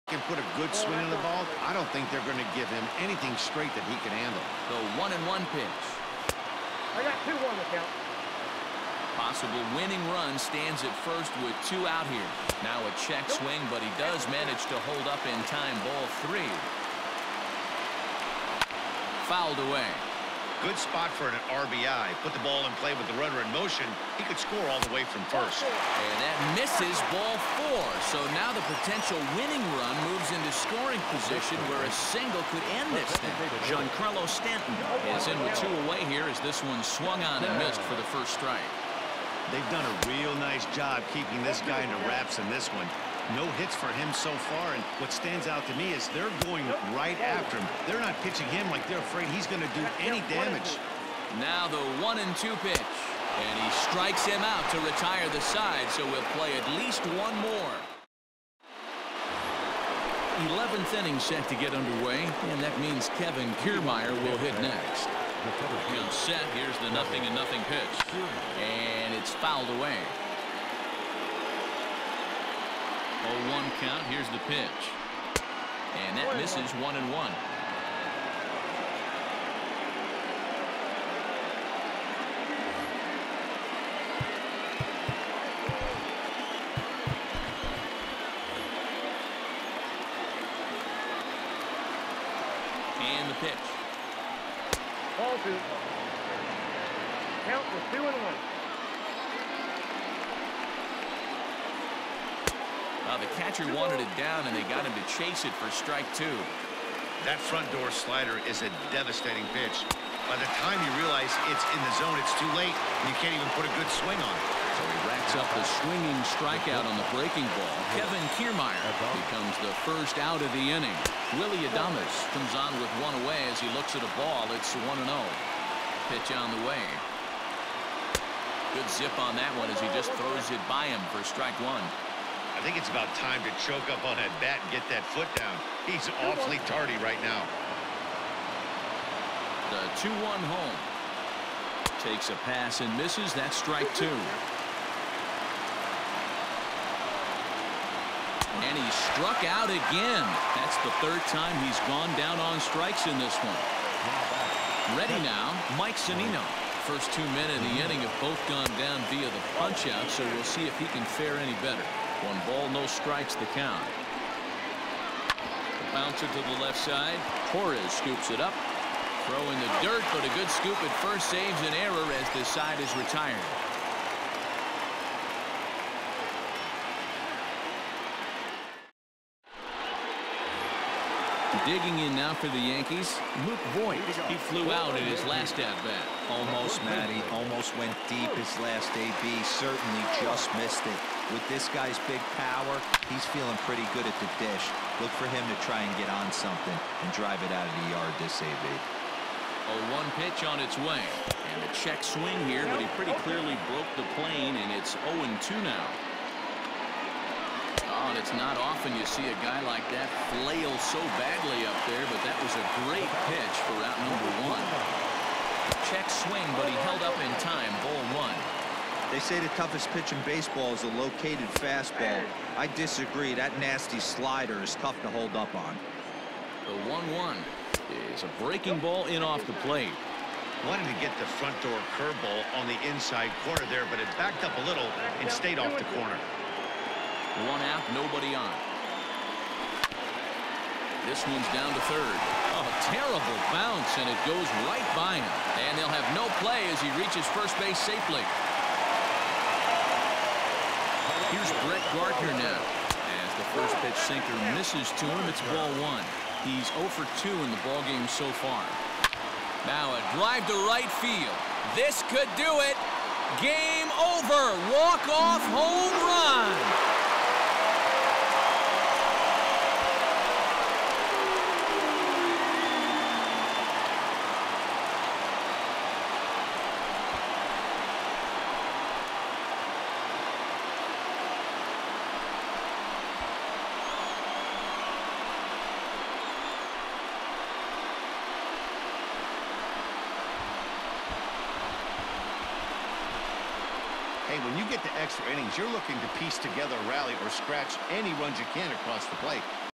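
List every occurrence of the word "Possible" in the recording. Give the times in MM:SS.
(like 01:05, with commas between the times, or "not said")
00:09.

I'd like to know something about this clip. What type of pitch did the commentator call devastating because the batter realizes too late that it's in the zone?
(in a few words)
Front door slider.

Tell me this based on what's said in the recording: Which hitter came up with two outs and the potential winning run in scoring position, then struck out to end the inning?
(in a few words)
Giancarlo Stanton.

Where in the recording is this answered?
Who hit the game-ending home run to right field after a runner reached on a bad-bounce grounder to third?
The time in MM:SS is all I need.
04:11.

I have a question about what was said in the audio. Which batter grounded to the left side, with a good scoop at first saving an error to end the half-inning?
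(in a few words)
Mike Zunino.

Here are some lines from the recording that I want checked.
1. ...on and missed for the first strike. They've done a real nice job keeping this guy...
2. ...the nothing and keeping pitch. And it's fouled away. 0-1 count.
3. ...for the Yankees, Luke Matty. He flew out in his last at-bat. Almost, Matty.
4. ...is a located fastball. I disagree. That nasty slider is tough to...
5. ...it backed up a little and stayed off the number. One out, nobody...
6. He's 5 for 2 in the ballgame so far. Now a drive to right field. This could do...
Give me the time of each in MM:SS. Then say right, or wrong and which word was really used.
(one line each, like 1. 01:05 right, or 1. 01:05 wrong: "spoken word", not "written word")
1. 00:37 right
2. 01:06 wrong: "nothing", not "keeping"
3. 03:02 wrong: "Voit", not "Matty"
4. 03:40 right
5. 03:53 wrong: "corner", not "number"
6. 04:16 wrong: "0", not "5".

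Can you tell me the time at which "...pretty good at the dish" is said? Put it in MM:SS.
03:13.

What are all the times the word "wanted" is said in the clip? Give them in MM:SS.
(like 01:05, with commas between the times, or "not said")
01:43, 03:50.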